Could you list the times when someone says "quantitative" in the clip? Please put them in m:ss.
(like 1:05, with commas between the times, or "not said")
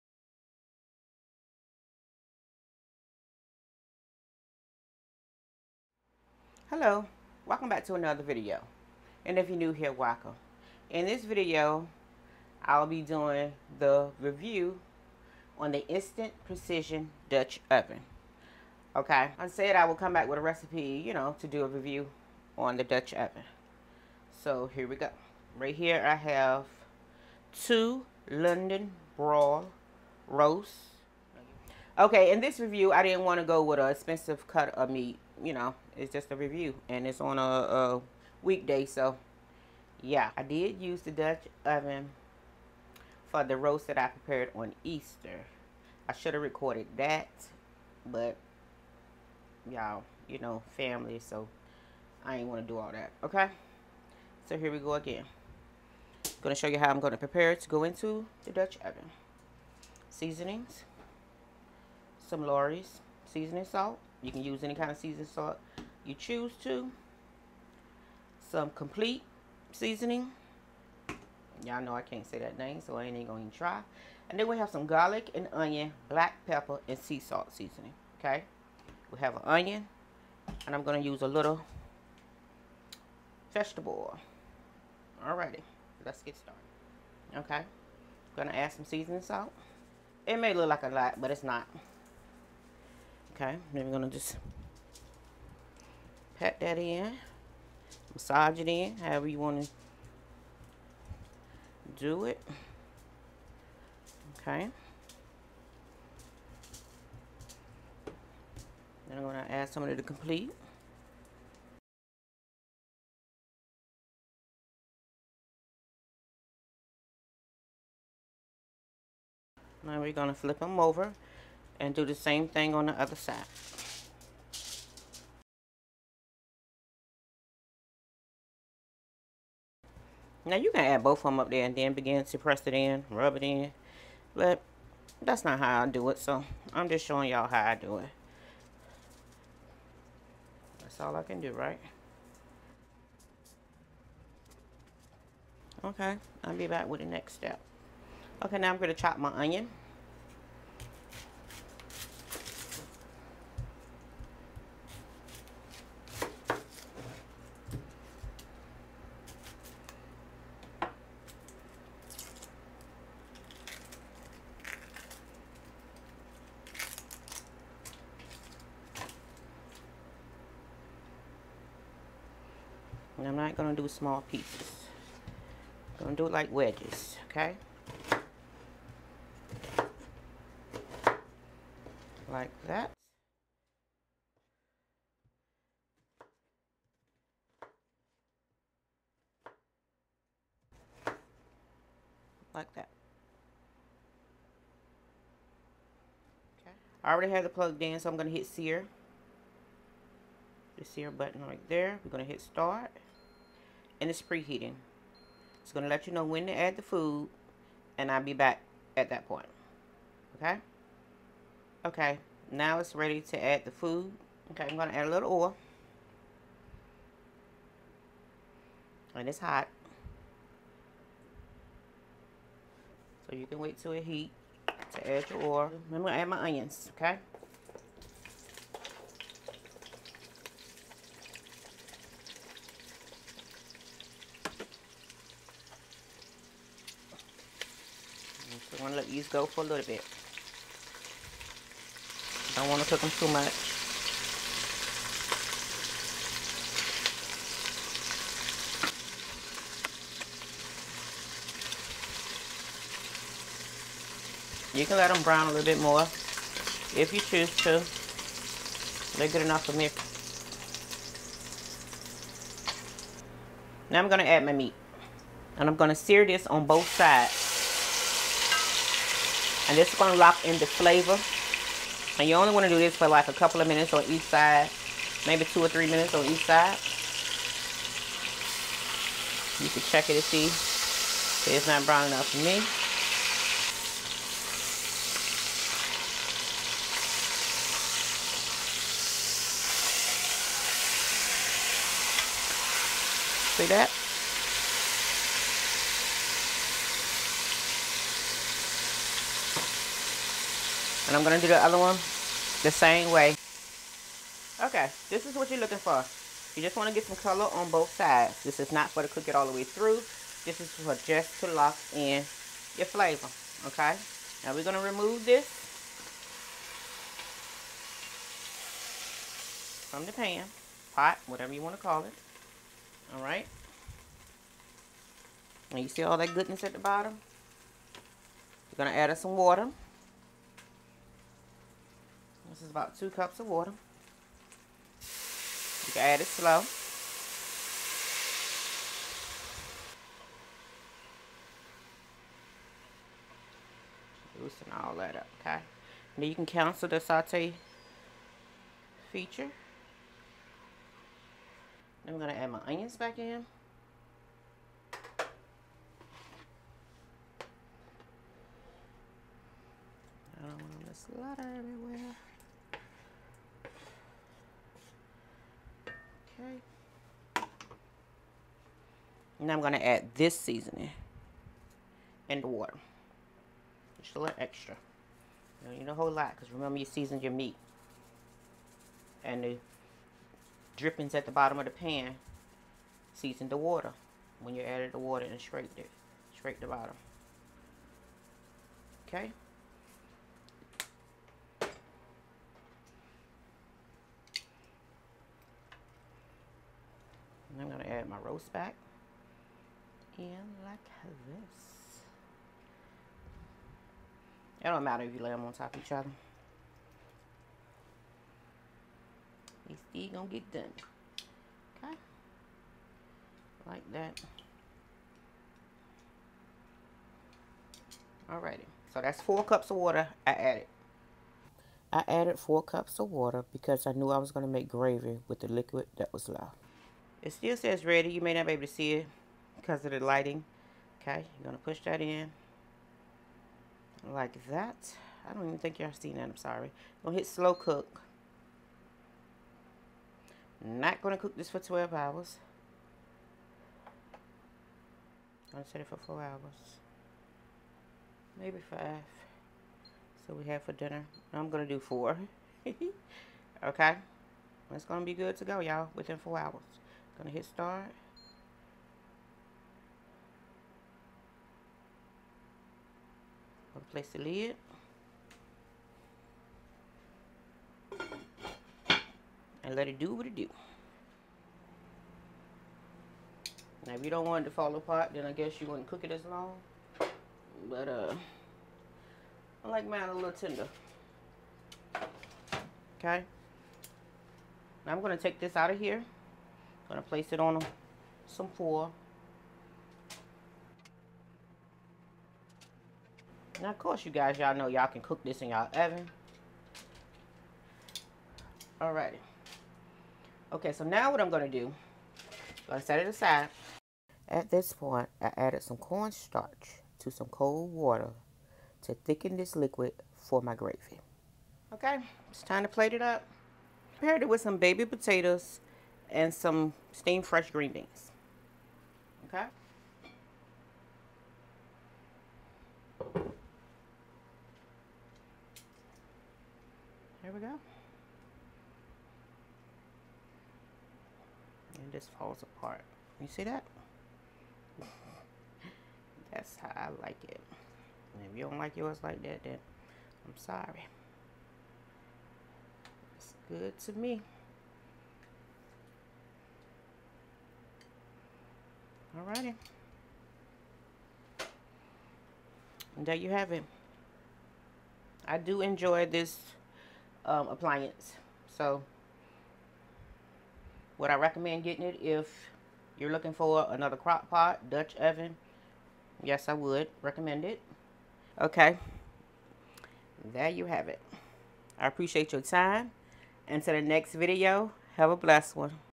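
not said.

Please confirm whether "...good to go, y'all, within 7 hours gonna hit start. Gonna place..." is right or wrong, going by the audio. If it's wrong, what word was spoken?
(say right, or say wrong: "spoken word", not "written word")
wrong: "4", not "7".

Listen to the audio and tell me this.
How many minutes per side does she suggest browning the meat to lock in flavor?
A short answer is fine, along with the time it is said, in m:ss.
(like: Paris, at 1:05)
2 or 3 minutes, at 4:35.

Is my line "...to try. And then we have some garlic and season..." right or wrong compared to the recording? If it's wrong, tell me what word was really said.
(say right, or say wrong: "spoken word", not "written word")
wrong: "onion", not "season".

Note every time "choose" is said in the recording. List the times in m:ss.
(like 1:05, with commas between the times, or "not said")
1:06, 4:17.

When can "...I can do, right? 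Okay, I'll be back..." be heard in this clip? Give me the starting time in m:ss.
2:21.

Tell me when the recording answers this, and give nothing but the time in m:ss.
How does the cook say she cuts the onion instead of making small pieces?
2:56.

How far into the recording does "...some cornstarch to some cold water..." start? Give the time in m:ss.
8:25.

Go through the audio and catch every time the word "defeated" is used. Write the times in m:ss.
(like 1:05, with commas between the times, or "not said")
not said.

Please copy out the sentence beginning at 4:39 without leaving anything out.
You can check it to see if it's not brown enough for me.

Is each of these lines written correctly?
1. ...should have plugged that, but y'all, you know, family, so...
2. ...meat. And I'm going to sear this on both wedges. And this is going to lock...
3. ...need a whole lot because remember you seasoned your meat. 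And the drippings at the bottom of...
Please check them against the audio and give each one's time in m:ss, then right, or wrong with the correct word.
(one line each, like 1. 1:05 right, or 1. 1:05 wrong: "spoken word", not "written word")
1. 0:46 wrong: "recorded", not "plugged"
2. 4:24 wrong: "sides", not "wedges"
3. 6:15 right.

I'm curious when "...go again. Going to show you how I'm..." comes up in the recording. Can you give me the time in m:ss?
0:54.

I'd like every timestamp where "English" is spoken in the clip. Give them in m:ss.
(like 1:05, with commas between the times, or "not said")
not said.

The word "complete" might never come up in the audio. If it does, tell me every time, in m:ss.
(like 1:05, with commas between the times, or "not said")
1:08, 1:50.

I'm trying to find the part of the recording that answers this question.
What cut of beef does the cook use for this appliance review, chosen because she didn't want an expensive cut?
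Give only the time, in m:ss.
0:28.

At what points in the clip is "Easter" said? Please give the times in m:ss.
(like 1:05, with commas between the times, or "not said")
0:44.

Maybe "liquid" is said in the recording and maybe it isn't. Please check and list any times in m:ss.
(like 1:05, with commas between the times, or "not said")
7:05, 8:29.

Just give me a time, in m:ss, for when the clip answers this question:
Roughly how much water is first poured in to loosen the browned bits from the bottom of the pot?
5:32.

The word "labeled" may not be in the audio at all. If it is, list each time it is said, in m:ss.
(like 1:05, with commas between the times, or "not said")
not said.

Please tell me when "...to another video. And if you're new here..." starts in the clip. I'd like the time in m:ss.
0:07.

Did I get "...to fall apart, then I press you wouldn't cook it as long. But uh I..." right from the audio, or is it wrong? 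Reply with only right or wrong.
wrong.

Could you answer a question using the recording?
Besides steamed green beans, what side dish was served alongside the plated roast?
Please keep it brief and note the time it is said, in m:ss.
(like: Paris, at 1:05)
Baby potatoes, at 8:34.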